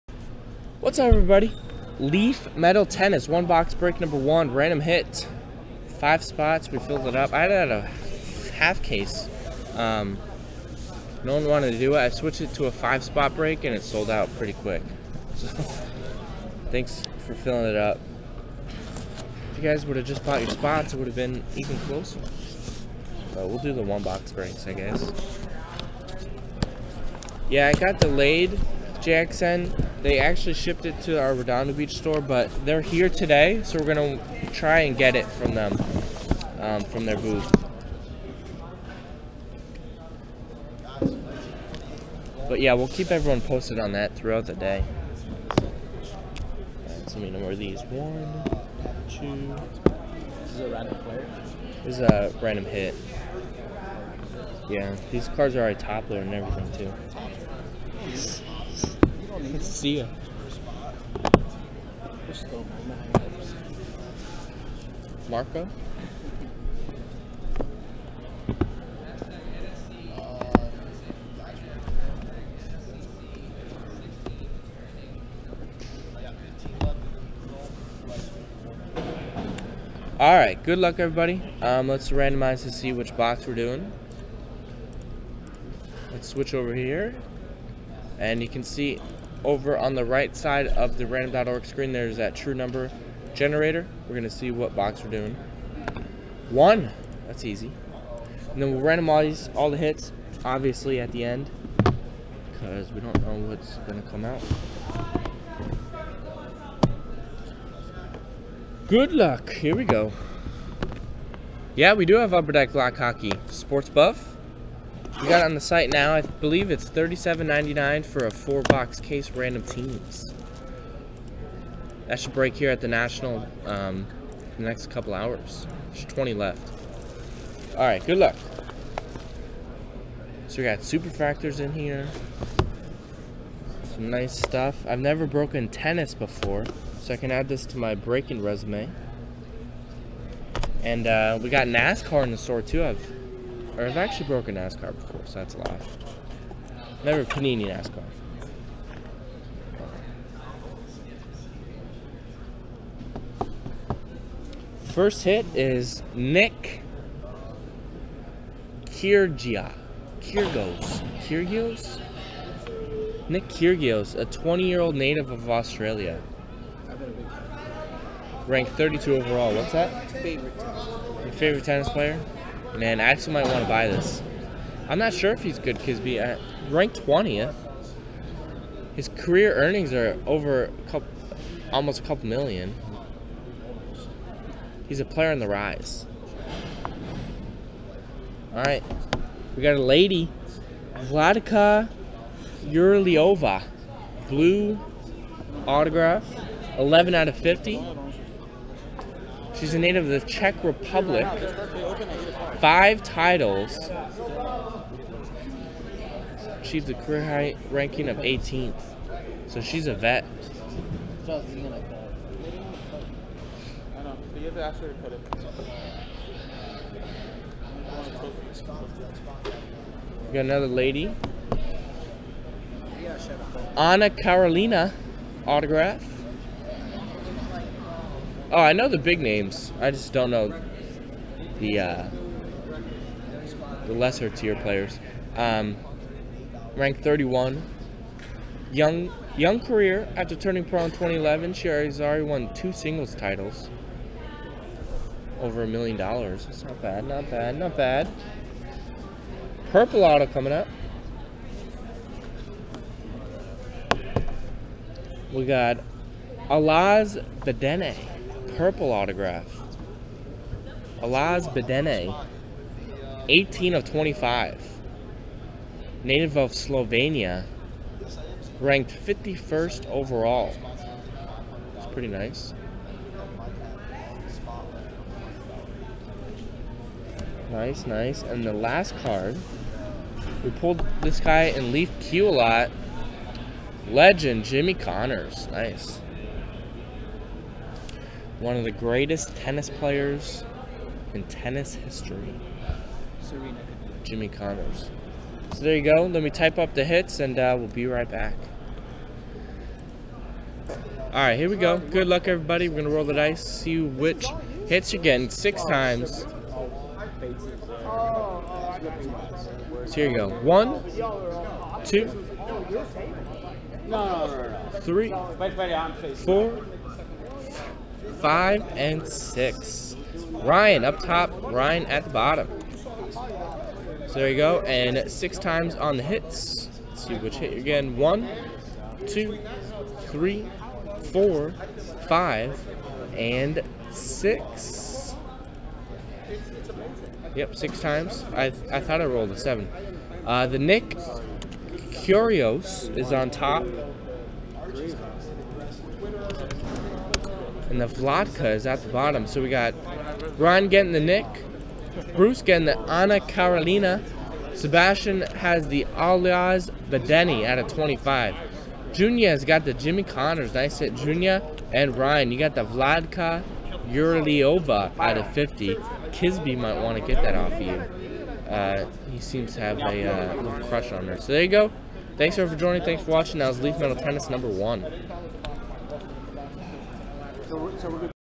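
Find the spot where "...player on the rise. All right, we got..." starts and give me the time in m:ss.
3:05.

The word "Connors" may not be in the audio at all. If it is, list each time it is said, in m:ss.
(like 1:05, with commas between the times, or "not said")
4:44, 4:54, 6:00.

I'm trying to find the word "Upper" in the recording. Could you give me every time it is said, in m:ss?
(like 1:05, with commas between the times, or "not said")
1:52.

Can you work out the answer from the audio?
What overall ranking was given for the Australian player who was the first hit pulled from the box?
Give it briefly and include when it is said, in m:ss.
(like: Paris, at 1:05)
32, at 2:48.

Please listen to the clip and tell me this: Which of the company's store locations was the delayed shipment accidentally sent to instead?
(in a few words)
Redondo Beach.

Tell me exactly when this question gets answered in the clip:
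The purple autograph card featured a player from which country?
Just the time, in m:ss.
4:26.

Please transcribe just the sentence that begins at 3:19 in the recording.
She's a native of the Czech Republic.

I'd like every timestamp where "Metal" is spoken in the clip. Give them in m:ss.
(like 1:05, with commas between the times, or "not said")
0:02, 6:13.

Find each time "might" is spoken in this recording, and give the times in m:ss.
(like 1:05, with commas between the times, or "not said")
2:53, 6:06.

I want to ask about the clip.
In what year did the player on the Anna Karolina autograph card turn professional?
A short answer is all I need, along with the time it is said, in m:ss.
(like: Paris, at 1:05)
2011, at 4:00.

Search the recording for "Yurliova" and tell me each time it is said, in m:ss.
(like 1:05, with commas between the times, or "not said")
3:12, 6:03.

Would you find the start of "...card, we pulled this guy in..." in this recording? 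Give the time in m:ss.
4:39.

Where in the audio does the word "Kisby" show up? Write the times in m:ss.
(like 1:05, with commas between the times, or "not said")
2:55, 6:06.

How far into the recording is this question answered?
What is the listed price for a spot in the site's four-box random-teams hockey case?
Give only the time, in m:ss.
1:56.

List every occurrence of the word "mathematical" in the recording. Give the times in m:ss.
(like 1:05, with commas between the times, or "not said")
not said.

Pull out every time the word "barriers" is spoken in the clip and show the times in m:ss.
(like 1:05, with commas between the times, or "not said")
not said.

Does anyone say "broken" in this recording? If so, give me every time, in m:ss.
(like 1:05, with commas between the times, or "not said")
2:15, 2:24.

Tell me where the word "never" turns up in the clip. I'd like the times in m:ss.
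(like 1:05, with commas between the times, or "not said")
2:14, 2:27.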